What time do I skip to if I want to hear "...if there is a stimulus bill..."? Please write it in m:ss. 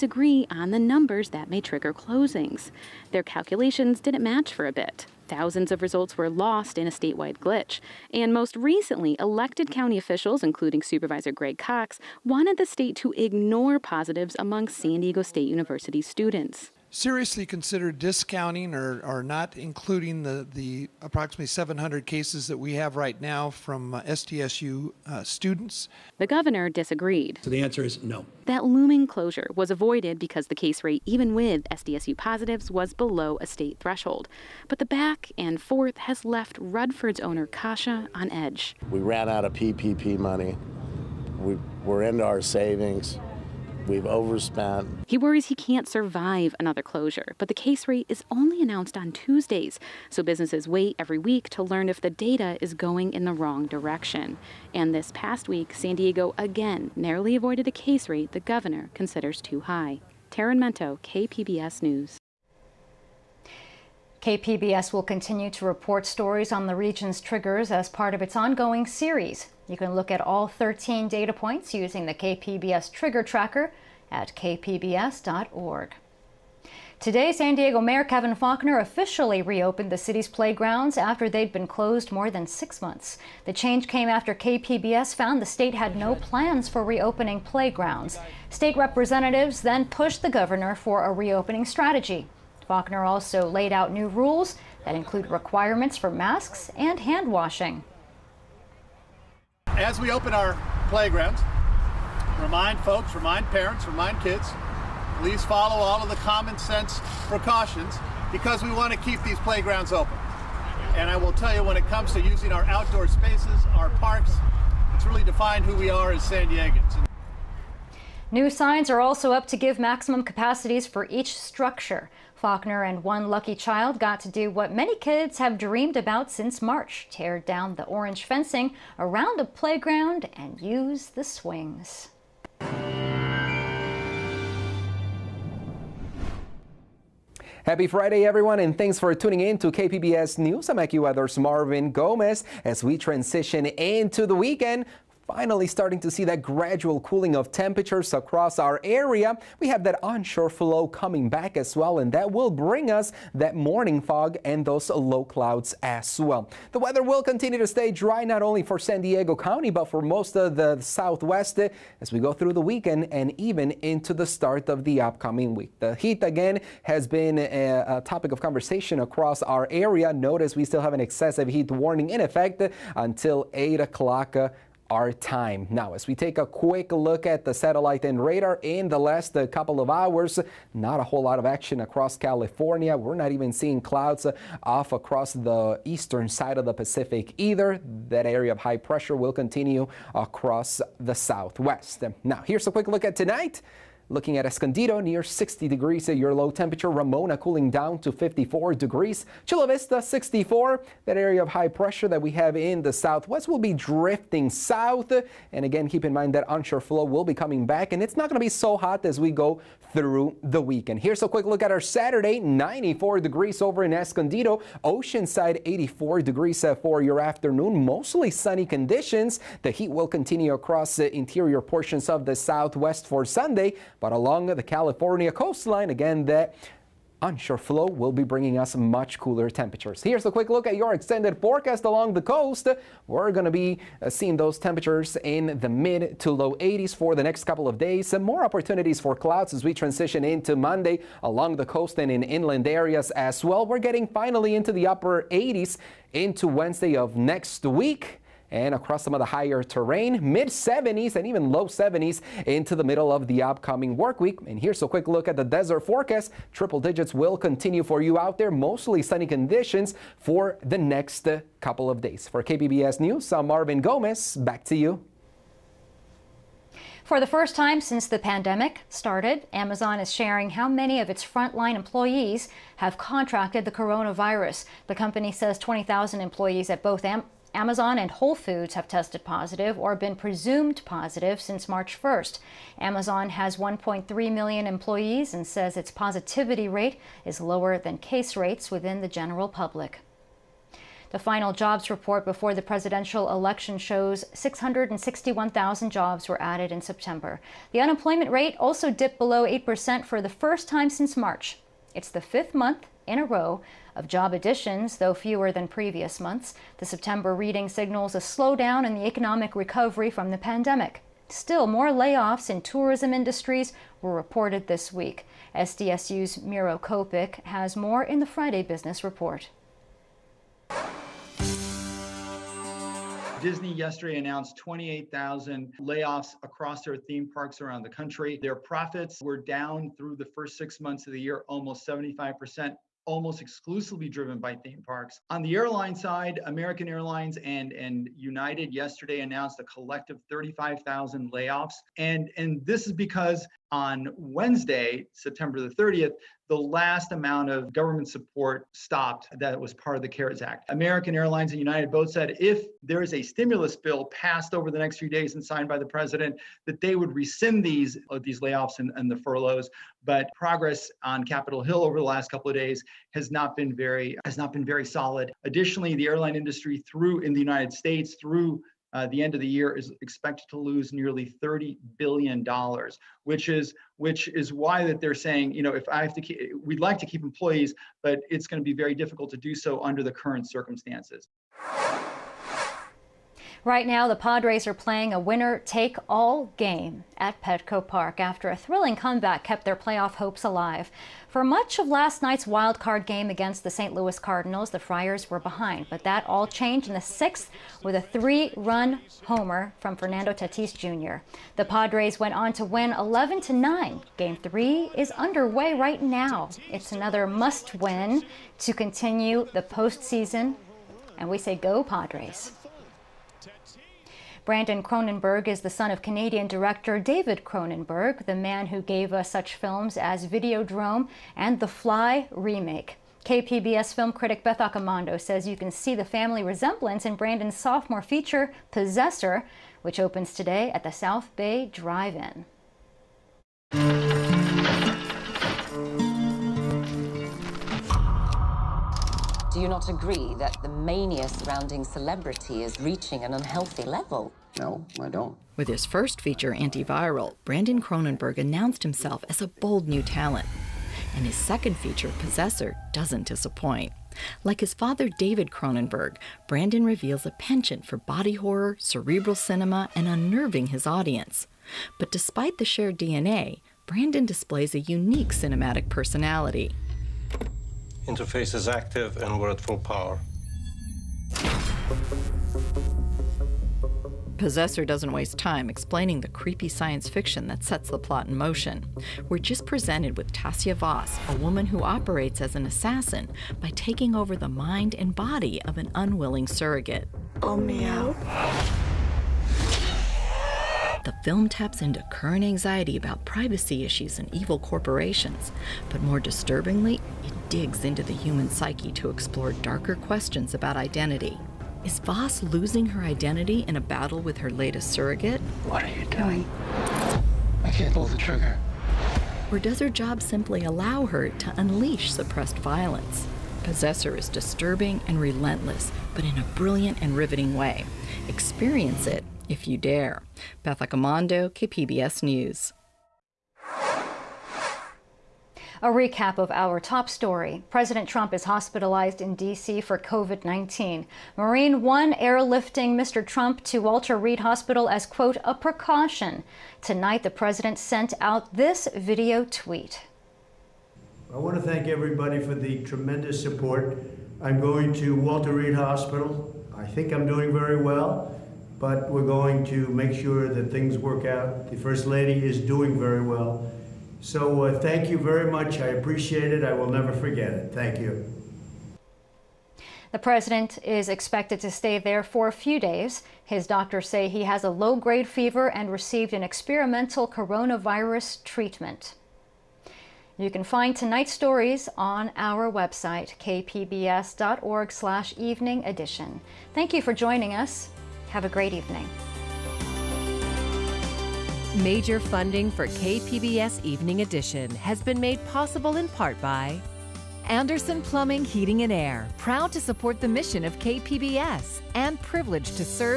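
5:52.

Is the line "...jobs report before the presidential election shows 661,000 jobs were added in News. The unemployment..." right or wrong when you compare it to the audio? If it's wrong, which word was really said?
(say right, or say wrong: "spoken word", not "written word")
wrong: "September", not "News".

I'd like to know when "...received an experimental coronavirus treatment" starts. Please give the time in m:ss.
9:25.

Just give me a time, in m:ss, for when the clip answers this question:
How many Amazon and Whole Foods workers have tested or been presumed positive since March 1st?
4:35.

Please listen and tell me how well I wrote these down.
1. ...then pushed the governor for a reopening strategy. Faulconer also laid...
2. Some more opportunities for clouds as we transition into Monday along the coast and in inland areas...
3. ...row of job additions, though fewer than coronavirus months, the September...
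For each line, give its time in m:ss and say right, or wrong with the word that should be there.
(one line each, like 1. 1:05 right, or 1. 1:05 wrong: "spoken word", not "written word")
1. 1:29 right
2. 3:58 right
3. 5:03 wrong: "previous", not "coronavirus".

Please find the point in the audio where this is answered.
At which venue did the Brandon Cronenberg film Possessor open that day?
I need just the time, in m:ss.
7:10.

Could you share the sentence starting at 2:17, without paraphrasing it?
Happy Friday, everyone, and thanks for tuning in to KPBS News.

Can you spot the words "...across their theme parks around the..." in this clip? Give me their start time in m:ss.
5:26.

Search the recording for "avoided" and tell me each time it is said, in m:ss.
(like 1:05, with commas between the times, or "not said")
0:29, 0:57.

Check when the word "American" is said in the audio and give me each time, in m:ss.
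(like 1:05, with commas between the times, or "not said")
5:36, 5:50.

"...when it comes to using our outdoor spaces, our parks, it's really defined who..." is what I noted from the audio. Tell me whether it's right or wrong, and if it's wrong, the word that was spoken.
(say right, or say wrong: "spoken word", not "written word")
right.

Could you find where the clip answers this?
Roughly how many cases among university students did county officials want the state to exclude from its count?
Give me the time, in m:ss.
0:21.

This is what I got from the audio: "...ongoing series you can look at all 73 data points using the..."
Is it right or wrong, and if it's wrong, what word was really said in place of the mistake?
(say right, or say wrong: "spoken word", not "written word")
wrong: "13", not "73".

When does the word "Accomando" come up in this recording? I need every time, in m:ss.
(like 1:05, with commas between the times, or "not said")
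7:04, 8:40.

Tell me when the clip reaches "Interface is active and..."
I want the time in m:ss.
7:48.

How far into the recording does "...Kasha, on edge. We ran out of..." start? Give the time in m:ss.
0:37.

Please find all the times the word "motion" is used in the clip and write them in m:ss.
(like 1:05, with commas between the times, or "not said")
7:58.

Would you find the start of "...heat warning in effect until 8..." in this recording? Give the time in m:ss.
2:51.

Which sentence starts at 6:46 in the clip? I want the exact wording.
It's another must win to continue the postseason, and we say go, Padres.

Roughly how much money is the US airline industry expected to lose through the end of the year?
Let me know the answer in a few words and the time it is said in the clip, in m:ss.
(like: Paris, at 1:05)
30 billion dollars, at 6:11.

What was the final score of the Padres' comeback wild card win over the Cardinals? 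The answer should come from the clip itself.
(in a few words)
11 to 9.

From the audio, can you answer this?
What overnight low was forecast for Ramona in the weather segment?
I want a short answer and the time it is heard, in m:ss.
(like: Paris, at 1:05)
54 degrees, at 3:18.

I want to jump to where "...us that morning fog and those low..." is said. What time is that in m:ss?
2:32.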